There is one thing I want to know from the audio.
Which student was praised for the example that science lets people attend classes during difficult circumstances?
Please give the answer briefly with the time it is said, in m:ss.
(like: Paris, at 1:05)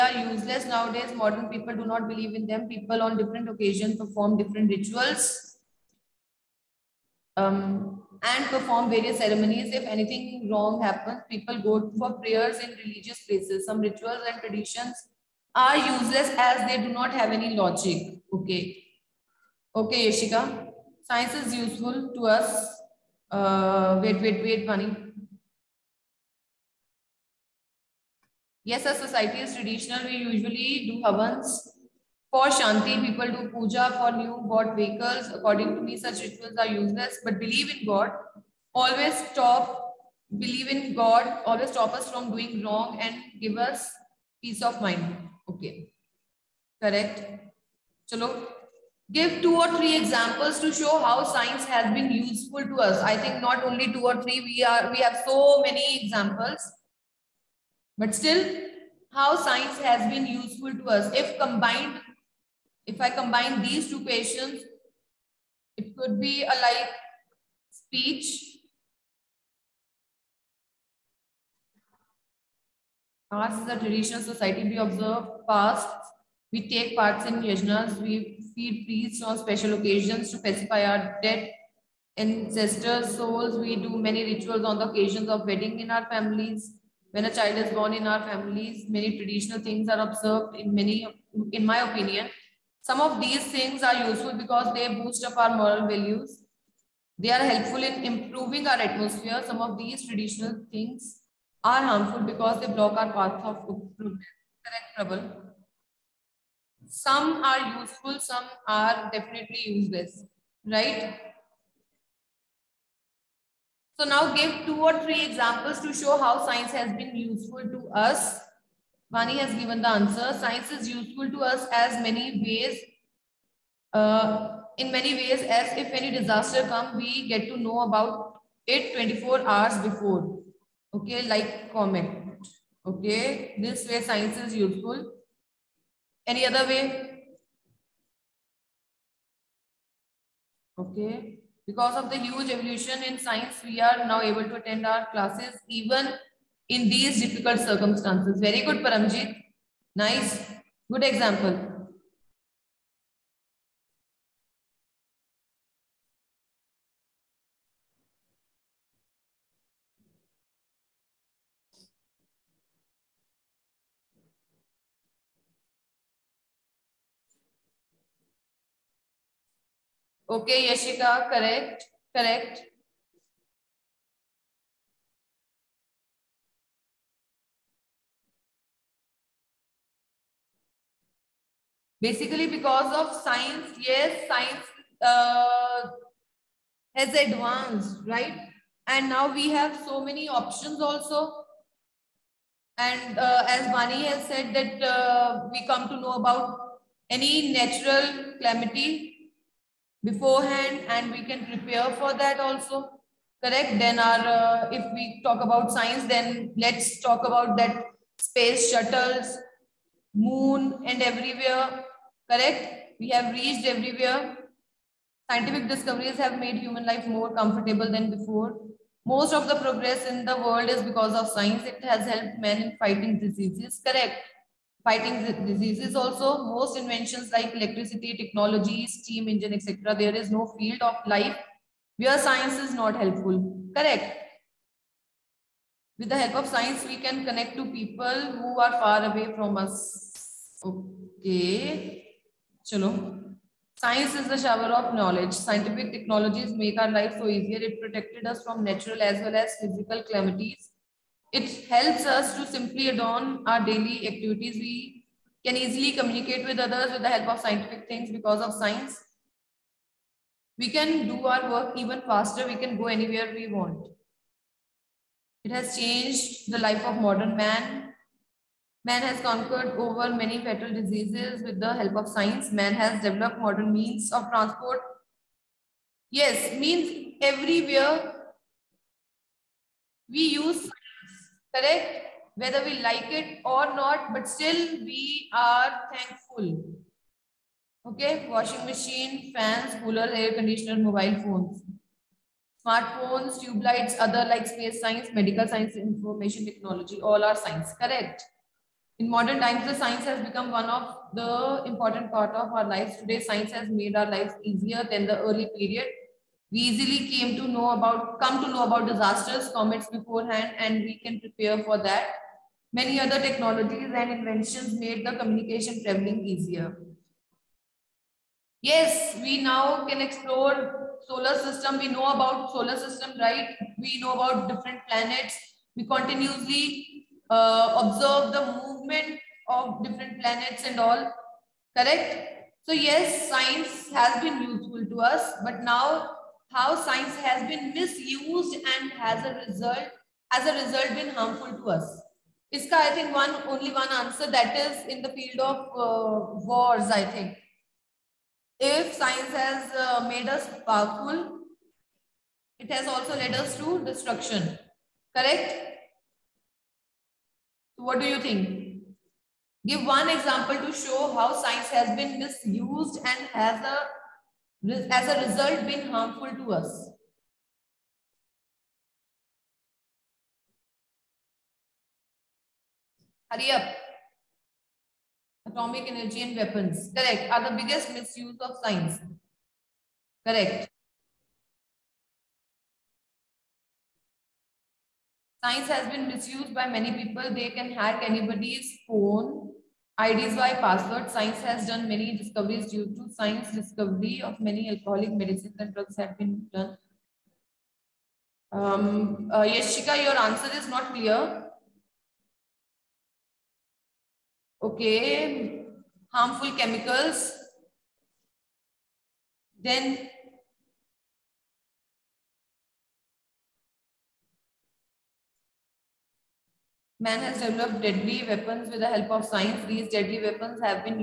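Paramjit, at 2:28.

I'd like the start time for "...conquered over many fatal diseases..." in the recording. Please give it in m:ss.
4:29.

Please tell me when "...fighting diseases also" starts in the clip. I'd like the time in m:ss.
3:44.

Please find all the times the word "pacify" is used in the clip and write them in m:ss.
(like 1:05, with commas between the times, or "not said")
1:20.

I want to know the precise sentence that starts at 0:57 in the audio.
But still, how science has been useful to us.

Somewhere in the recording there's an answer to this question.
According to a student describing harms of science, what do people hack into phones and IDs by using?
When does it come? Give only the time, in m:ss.
6:30.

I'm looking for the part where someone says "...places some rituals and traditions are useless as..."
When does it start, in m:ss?
0:13.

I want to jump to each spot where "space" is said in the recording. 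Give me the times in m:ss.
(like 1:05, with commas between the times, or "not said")
3:28, 4:54.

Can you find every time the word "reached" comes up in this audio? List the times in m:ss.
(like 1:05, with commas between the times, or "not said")
3:33.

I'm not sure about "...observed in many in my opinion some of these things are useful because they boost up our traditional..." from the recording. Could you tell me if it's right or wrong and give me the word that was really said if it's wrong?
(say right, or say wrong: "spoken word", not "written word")
wrong: "moral", not "traditional".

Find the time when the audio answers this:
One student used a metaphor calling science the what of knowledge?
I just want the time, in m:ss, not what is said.
4:03.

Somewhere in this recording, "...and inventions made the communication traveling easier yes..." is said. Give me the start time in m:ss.
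5:13.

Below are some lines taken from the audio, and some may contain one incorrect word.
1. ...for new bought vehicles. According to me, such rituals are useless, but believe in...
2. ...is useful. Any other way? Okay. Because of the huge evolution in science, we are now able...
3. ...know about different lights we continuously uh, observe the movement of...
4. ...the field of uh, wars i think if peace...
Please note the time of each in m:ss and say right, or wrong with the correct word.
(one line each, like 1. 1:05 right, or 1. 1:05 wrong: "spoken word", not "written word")
1. 0:33 right
2. 2:14 right
3. 5:23 wrong: "planets", not "lights"
4. 5:45 wrong: "science", not "peace".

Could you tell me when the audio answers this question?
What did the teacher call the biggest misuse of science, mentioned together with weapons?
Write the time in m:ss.
6:15.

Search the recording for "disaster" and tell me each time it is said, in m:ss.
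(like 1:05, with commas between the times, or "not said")
2:06, 5:08.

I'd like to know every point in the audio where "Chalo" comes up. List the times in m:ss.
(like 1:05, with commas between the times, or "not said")
0:48, 4:02.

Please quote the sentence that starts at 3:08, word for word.
And now we have so many options also.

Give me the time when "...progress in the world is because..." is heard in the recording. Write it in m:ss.
3:39.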